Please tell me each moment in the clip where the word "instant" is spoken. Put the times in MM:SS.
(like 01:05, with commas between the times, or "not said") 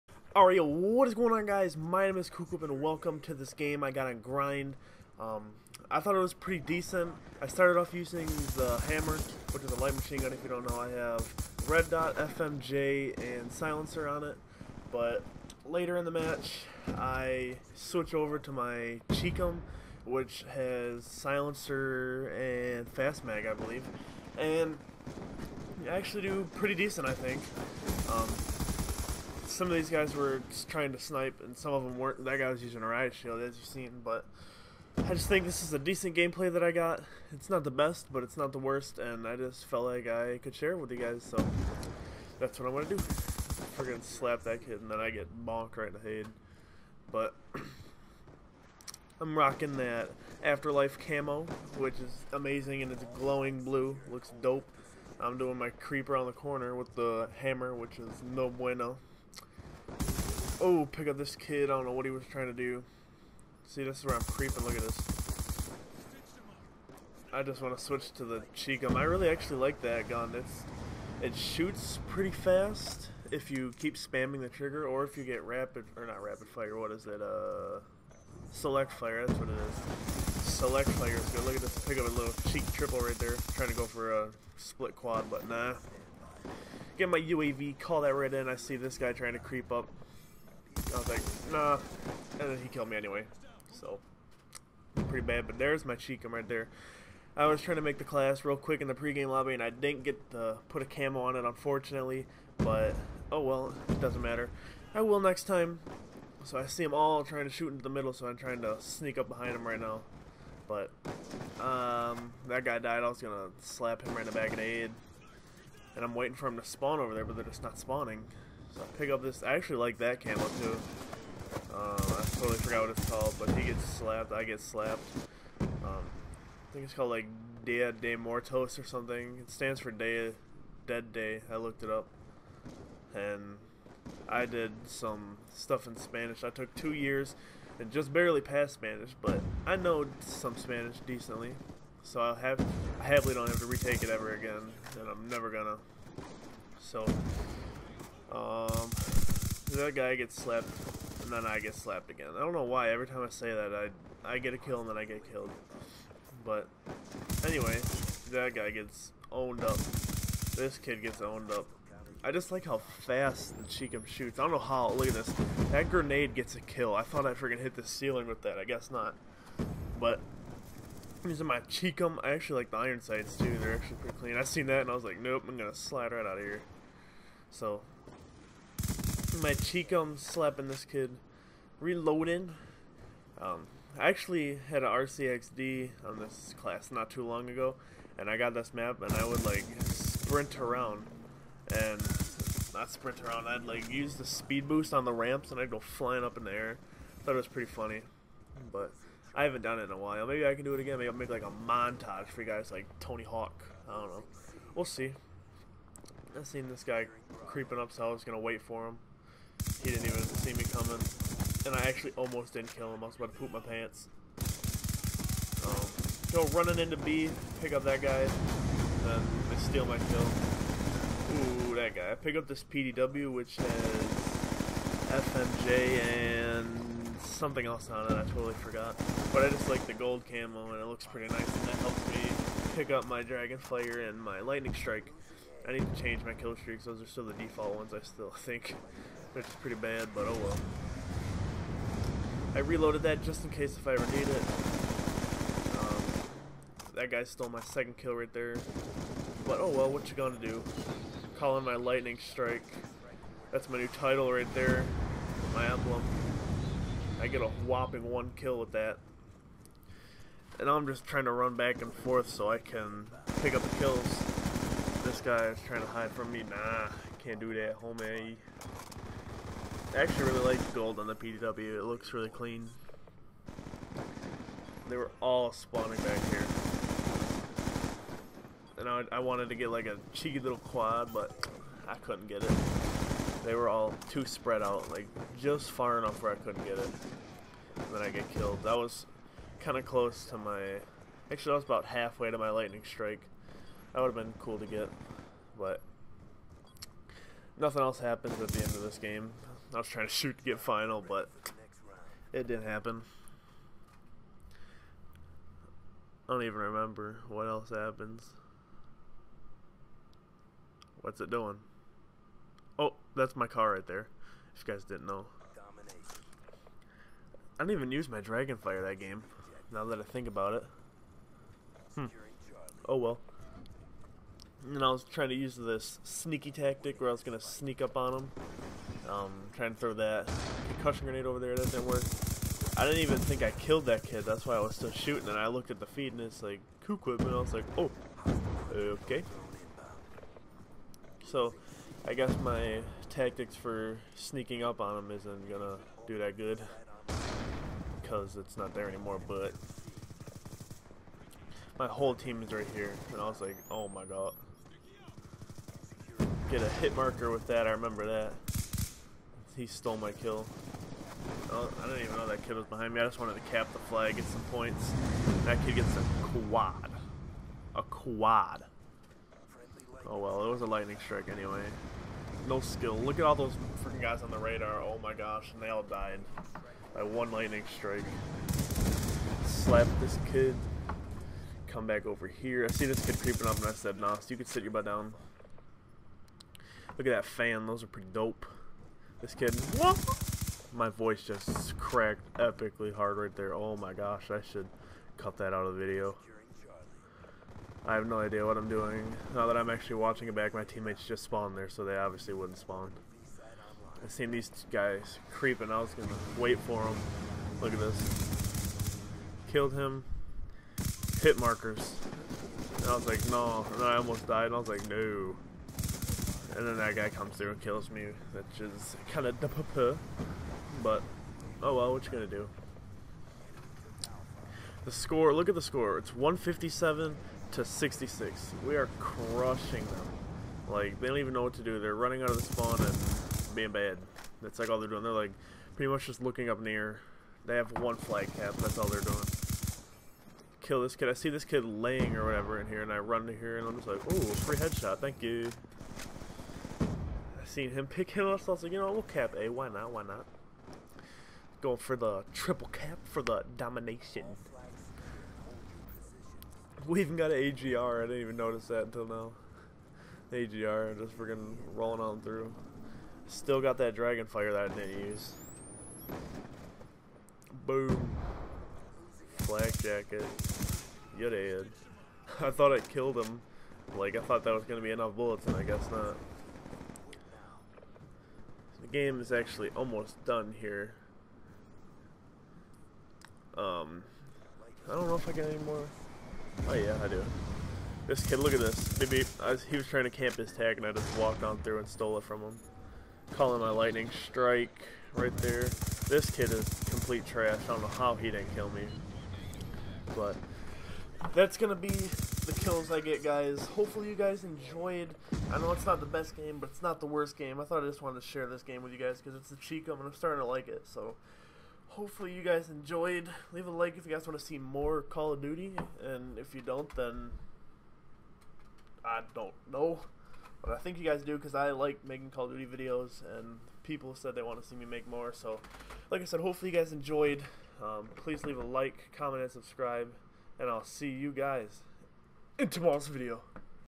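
not said.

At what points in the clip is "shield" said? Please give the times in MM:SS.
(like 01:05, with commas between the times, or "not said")
00:33.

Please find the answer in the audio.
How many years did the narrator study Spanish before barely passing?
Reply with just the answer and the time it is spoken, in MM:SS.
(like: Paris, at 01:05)
2, at 02:16.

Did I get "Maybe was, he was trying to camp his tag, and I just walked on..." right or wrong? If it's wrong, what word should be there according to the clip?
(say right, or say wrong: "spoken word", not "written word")
right.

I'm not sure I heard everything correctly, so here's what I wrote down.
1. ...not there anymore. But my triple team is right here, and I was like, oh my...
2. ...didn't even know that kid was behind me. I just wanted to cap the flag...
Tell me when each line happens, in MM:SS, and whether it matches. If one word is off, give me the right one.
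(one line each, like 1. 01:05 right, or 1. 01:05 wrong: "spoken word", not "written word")
1. 05:48 wrong: "whole", not "triple"
2. 06:01 right.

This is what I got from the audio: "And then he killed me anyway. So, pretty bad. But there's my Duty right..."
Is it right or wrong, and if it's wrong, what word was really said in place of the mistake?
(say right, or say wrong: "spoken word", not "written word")
wrong: "Chicom", not "Duty".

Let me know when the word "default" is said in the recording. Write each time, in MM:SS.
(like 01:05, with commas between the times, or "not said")
03:57.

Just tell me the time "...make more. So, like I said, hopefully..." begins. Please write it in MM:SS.
08:44.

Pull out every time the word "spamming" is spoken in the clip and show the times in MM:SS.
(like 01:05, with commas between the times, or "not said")
01:13.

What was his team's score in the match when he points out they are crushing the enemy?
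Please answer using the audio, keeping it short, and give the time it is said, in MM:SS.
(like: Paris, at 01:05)
157, at 07:06.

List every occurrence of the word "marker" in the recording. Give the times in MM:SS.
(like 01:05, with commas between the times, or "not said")
05:56, 06:51.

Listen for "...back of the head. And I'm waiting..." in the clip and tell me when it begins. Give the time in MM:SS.
01:54.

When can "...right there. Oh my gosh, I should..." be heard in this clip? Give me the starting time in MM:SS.
06:33.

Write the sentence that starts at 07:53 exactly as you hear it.
Like, I thought that was going to be enough bullets, and I guess not game is actually almost done here.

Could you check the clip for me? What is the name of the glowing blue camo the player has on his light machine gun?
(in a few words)
Afterlife.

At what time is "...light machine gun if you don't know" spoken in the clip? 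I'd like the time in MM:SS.
00:09.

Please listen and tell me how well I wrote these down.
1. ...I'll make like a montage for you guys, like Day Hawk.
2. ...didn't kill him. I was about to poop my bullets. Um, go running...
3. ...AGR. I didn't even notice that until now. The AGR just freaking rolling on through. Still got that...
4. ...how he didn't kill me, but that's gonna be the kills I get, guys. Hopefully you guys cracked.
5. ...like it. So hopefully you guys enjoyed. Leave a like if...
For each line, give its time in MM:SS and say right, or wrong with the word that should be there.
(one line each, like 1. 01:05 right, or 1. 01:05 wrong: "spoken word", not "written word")
1. 03:21 wrong: "Tony", not "Day"
2. 03:32 wrong: "pants", not "bullets"
3. 07:37 right
4. 08:17 wrong: "enjoyed", not "cracked"
5. 08:30 right.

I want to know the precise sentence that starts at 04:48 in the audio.
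That was kind of close to my...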